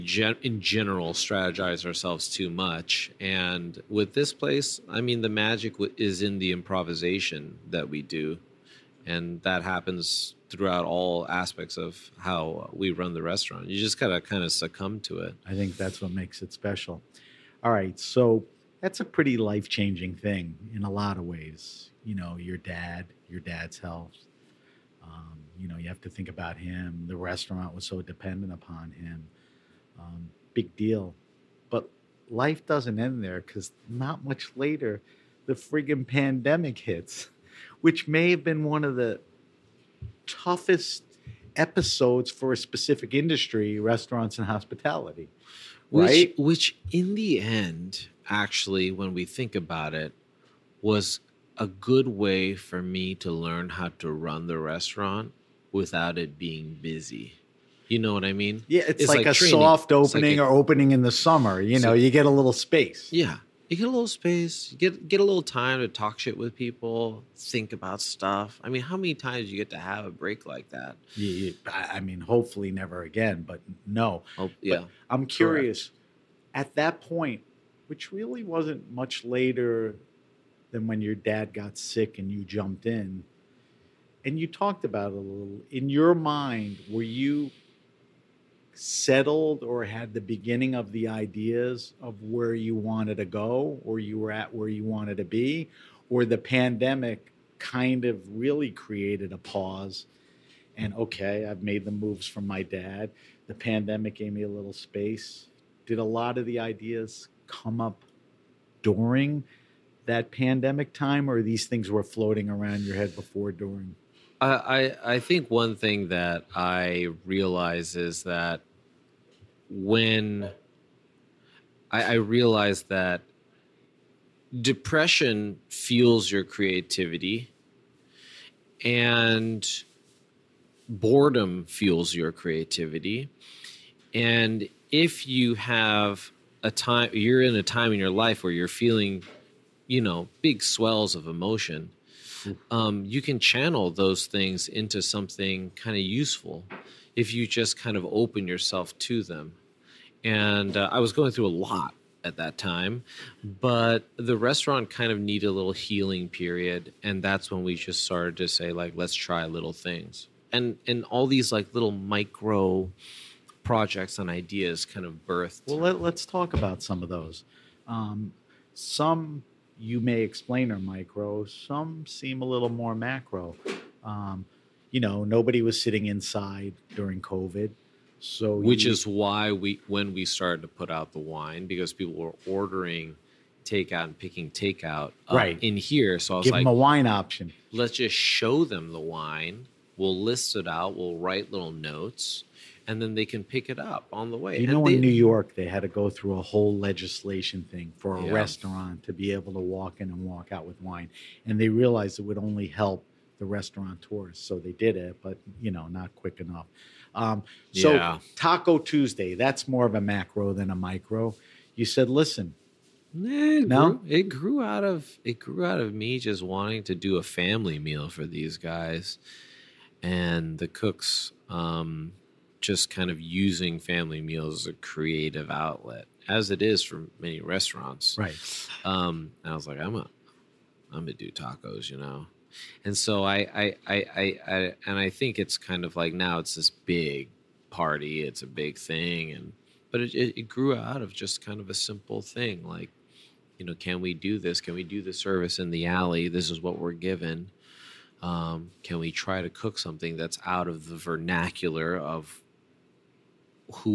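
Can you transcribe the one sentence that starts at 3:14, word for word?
You know, they, in New York, they had to go through a whole legislation thing for a yeah.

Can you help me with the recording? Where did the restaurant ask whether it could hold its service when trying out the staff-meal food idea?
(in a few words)
the alley.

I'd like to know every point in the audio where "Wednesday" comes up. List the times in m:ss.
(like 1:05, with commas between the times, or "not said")
not said.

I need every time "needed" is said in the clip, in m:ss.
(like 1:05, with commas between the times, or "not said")
2:35.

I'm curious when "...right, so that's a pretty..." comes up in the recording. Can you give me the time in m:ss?
0:17.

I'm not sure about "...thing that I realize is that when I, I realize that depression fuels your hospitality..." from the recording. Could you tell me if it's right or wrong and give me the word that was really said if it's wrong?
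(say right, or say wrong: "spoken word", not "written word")
wrong: "creativity", not "hospitality".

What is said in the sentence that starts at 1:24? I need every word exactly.
And you talked about it a little.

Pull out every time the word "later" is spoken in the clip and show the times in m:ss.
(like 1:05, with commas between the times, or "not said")
0:34, 1:19.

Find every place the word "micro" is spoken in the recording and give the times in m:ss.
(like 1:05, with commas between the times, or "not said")
2:41, 2:50, 3:30.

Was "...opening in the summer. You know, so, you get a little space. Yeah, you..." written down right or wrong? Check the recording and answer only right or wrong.
right.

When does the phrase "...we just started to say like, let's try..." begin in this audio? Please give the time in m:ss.
2:37.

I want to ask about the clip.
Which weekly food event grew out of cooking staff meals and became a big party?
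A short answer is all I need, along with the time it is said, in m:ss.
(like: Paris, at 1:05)
Taco Tuesday, at 3:28.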